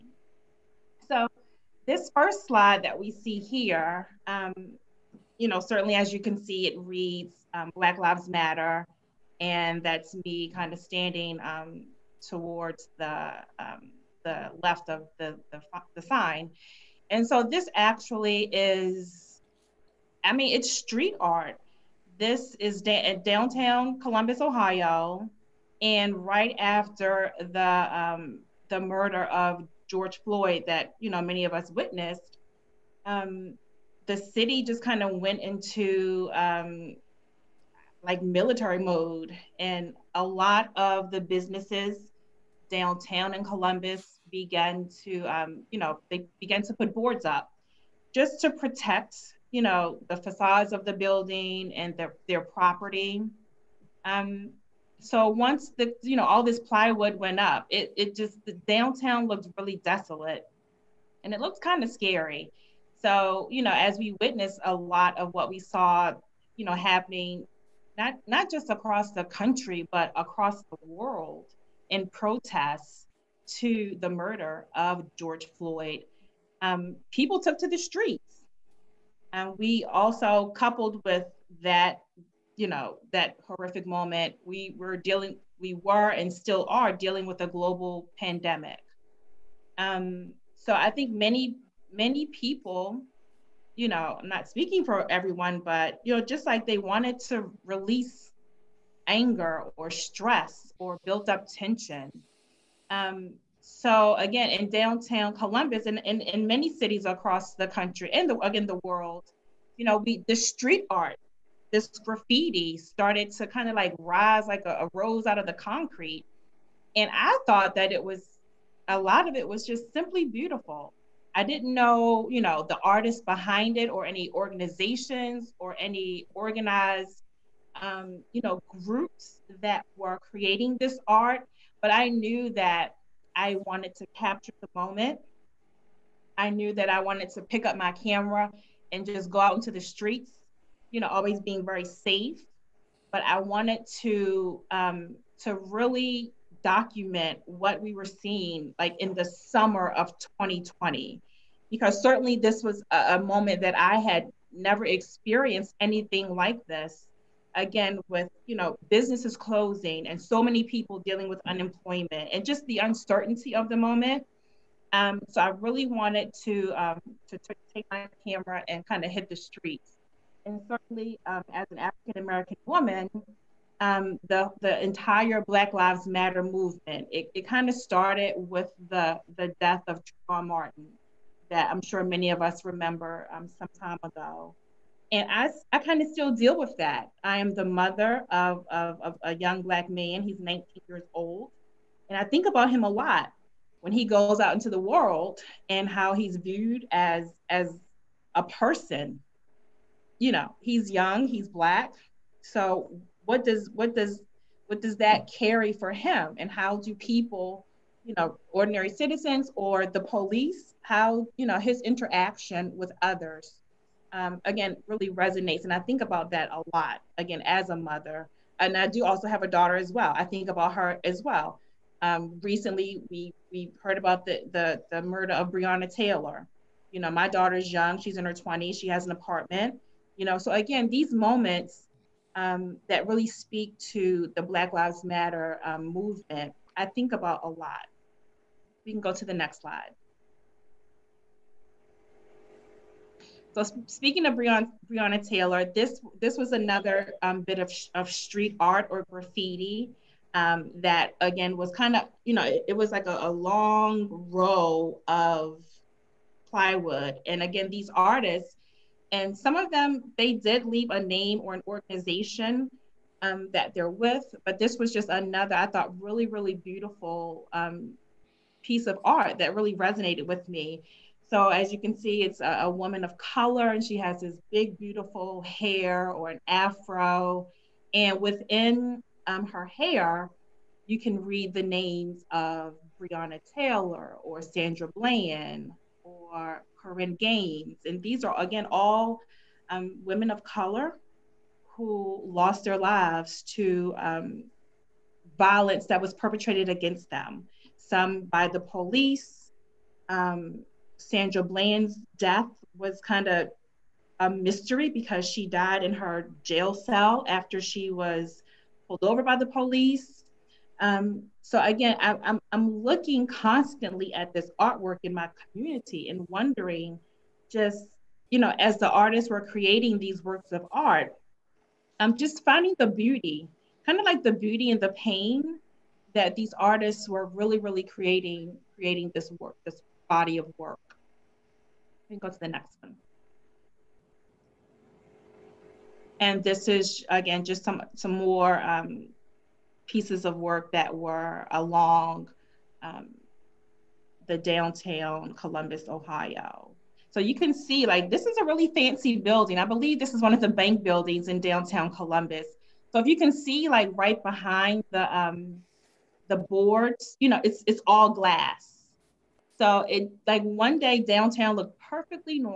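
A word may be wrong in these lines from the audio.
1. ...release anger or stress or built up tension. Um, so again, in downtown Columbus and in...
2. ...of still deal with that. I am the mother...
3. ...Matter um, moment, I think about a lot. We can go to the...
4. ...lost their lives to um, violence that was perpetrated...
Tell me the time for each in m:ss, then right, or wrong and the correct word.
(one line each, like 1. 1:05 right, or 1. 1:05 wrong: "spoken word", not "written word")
1. 1:37 right
2. 3:06 right
3. 3:55 wrong: "movement", not "moment"
4. 4:52 right.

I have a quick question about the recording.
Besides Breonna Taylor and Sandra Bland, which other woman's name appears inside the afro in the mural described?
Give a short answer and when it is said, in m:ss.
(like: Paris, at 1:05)
Korryn Gaines, at 4:46.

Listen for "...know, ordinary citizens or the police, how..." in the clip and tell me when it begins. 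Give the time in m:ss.
3:28.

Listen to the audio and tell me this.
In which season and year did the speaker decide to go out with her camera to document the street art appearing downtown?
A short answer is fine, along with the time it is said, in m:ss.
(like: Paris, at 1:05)
Summer of 2020, at 2:29.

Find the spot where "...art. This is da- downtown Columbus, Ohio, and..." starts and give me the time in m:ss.
0:21.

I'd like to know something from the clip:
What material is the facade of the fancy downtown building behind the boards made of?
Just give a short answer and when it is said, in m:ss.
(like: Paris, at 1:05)
Glass, at 5:58.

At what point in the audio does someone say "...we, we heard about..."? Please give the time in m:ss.
3:43.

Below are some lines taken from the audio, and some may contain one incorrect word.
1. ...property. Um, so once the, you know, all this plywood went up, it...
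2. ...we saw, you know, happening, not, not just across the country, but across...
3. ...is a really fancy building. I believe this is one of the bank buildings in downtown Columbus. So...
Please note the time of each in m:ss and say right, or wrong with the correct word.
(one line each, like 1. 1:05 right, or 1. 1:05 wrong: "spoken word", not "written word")
1. 0:52 right
2. 1:05 right
3. 5:48 right.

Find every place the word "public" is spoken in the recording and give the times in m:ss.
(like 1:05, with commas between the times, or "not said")
not said.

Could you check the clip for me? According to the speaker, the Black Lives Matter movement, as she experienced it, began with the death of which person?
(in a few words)
Trayvon Martin.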